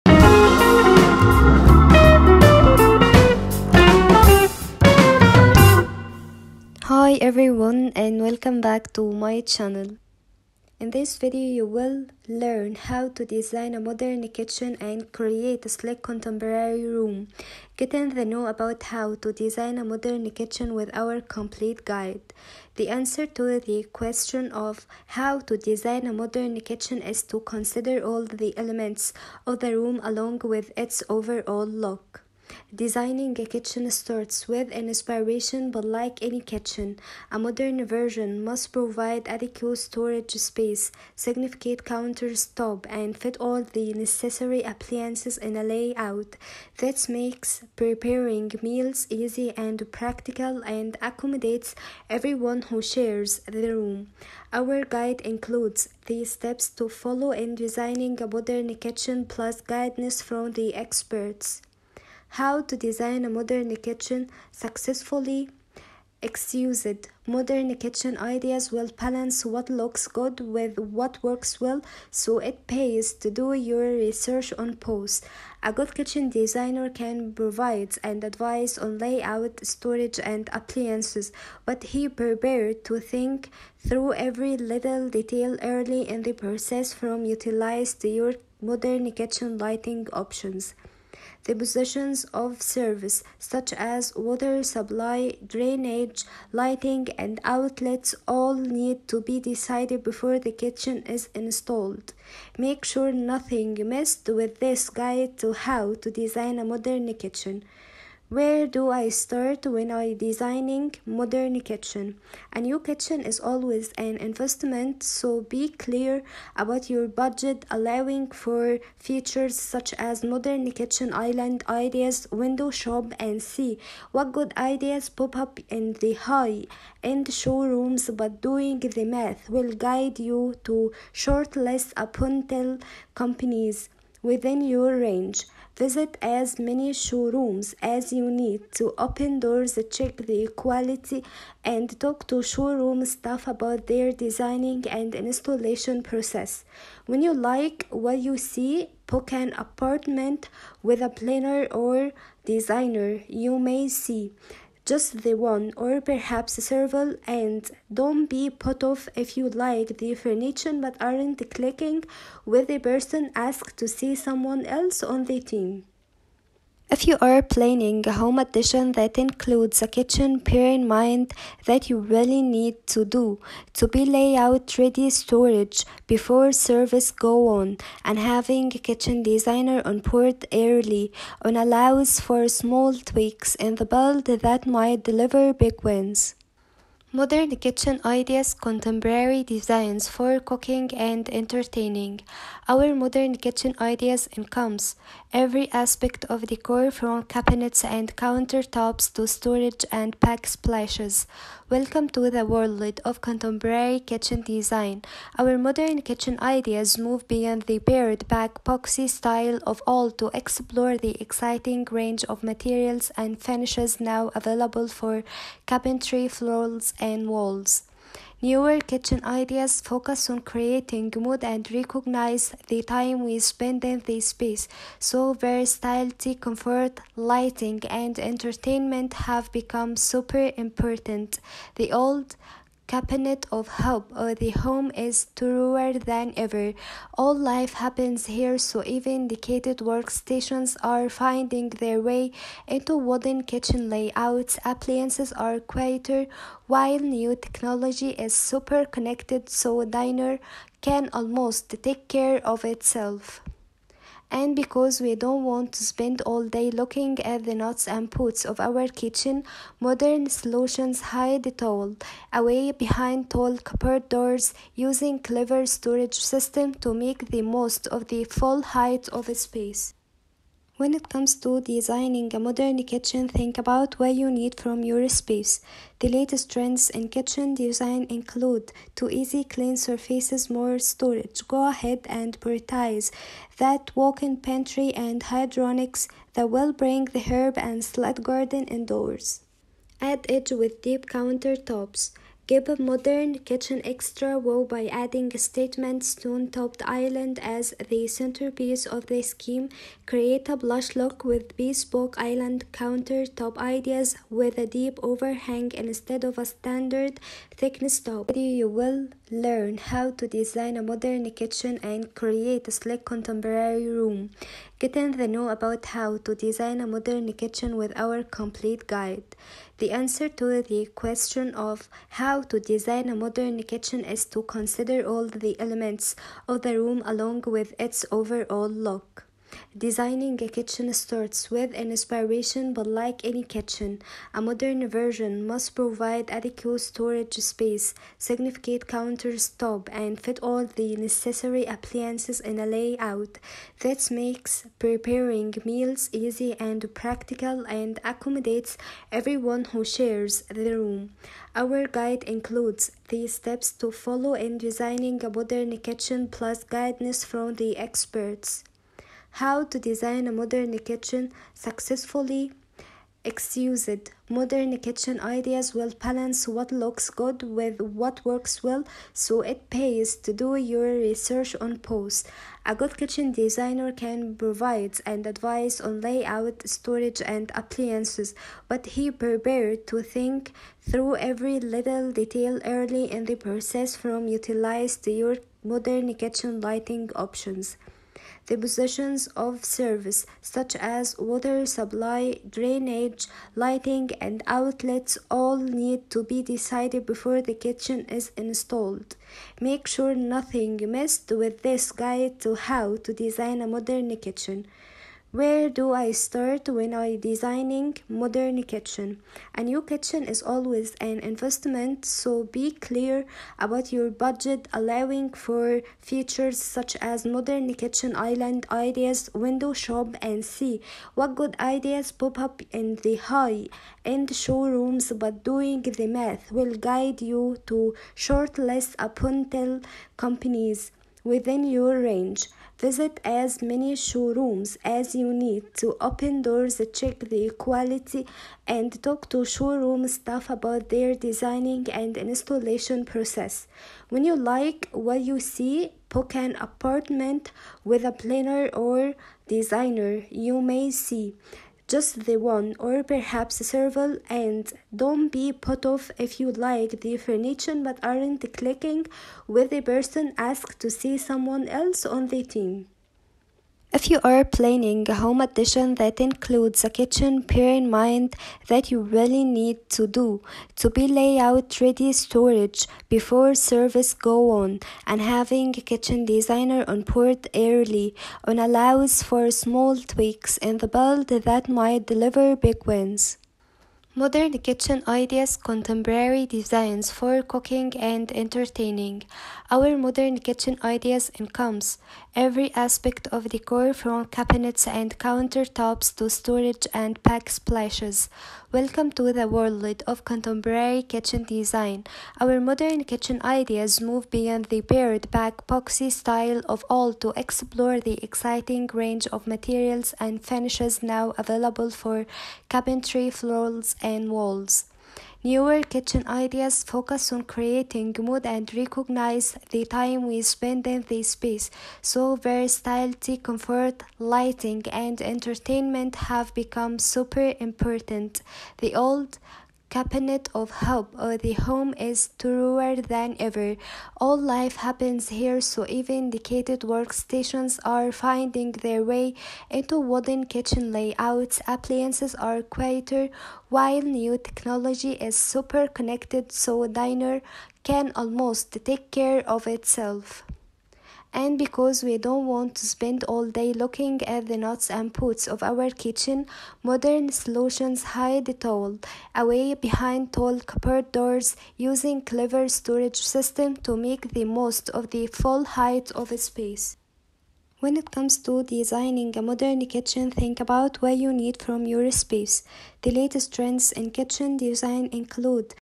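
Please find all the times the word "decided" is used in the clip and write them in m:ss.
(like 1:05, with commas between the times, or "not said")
1:39, 6:36.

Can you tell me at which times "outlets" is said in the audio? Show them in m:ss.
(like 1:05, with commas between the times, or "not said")
1:37, 6:34.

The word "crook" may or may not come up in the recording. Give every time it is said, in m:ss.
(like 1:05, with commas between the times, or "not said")
not said.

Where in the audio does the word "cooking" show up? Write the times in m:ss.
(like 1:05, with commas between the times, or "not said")
3:10, 8:07.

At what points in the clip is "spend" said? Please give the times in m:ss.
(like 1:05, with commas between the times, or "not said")
3:43, 4:15, 8:40, 9:12.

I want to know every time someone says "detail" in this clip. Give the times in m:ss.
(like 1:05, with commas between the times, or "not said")
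1:25, 6:22.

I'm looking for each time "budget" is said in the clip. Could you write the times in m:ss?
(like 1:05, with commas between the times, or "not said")
1:57, 6:54.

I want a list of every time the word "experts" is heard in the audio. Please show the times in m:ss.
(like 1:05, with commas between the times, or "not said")
1:00, 5:57.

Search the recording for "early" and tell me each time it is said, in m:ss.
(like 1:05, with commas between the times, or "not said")
1:25, 3:00, 6:22, 7:57.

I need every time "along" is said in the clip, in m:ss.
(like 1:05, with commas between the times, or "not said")
0:30, 5:27.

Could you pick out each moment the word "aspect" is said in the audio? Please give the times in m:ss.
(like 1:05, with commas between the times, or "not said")
3:15, 8:12.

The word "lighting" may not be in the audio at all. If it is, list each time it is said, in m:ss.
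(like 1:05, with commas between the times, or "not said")
1:29, 1:36, 3:47, 6:26, 6:33, 8:44.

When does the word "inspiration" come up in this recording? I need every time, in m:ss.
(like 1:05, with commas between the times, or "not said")
0:34, 5:31.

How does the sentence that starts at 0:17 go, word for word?
Get the know about how to design a modern kitchen with our complete guide.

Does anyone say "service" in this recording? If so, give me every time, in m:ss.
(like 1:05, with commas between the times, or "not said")
1:32, 2:56, 6:29, 7:53.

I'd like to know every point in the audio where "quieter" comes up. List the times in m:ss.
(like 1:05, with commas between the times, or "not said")
4:05, 9:02.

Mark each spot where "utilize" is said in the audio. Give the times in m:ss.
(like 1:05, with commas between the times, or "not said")
1:27, 6:24.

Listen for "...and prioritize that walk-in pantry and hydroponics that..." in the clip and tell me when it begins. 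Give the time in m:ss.
4:42.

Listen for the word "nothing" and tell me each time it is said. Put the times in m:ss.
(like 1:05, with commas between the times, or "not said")
1:43, 6:40.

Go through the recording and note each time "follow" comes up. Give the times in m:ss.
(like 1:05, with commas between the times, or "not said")
0:56, 5:53.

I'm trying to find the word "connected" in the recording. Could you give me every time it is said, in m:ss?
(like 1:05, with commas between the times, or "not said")
4:08, 9:05.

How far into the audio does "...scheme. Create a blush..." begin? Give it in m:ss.
4:59.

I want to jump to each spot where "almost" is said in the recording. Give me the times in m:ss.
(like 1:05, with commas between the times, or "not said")
4:11, 9:08.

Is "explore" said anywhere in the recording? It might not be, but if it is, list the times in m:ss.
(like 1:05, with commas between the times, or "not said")
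3:30, 8:27.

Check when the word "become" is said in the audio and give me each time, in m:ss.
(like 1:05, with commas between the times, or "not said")
3:49, 8:46.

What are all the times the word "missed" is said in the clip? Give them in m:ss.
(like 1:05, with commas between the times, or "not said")
1:43, 6:40.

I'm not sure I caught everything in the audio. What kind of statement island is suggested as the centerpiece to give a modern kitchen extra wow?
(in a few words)
stone topped island.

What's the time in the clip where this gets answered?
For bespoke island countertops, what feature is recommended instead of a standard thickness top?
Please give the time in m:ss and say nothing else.
5:04.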